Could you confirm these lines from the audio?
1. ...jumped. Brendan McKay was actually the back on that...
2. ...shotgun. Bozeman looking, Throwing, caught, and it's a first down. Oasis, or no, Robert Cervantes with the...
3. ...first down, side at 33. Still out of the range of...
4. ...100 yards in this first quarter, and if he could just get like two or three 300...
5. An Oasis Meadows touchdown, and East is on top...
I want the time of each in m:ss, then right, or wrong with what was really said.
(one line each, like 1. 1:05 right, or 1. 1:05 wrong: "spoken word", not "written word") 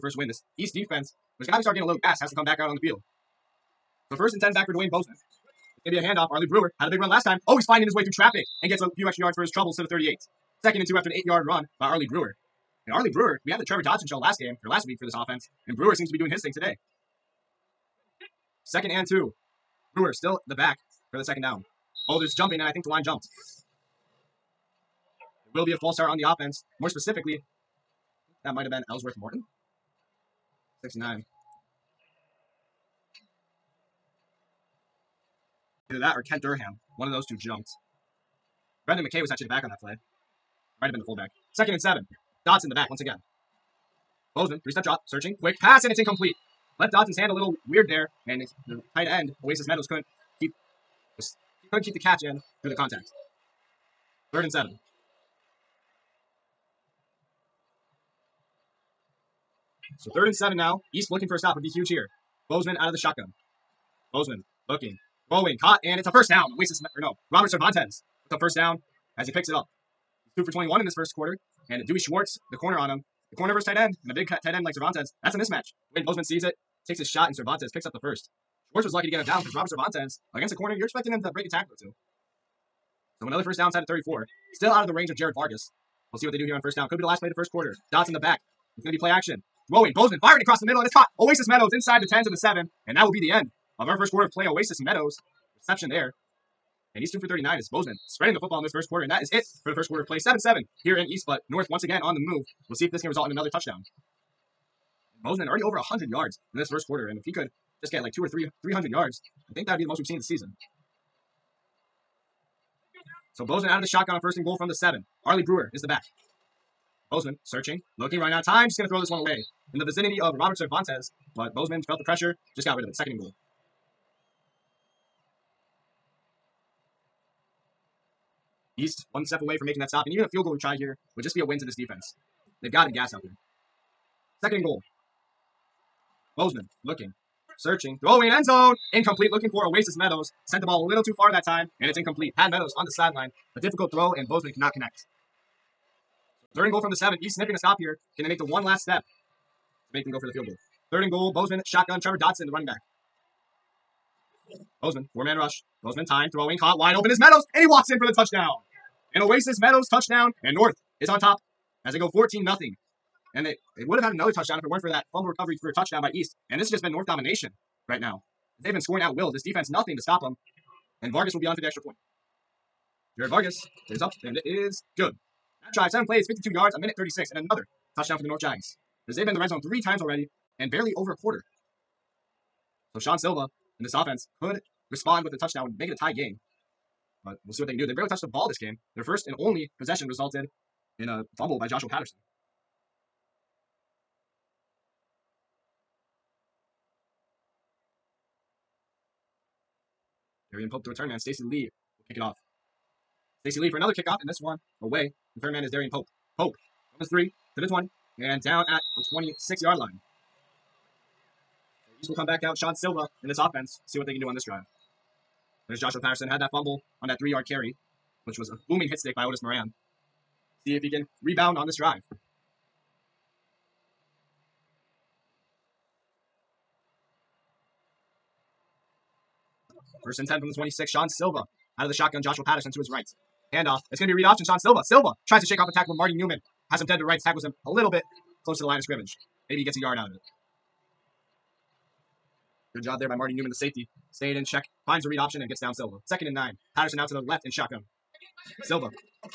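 1. 0:37 right
2. 1:02 right
3. 1:23 wrong: "34", not "33"
4. 1:45 right
5. 2:39 wrong: "North", not "East".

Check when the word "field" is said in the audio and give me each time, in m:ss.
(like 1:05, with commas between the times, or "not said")
0:02, 2:10, 2:30.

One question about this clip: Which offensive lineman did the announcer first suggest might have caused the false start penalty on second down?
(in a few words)
Ellsworth Morton.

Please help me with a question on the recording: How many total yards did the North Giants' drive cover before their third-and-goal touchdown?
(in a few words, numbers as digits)
52.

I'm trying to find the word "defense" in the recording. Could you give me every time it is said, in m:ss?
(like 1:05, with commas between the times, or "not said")
0:00, 2:11, 2:49.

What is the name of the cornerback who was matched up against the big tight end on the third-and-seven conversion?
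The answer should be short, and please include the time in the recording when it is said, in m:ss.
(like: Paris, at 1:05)
Dewey Schwartz, at 1:11.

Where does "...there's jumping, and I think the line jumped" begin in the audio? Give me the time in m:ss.
0:22.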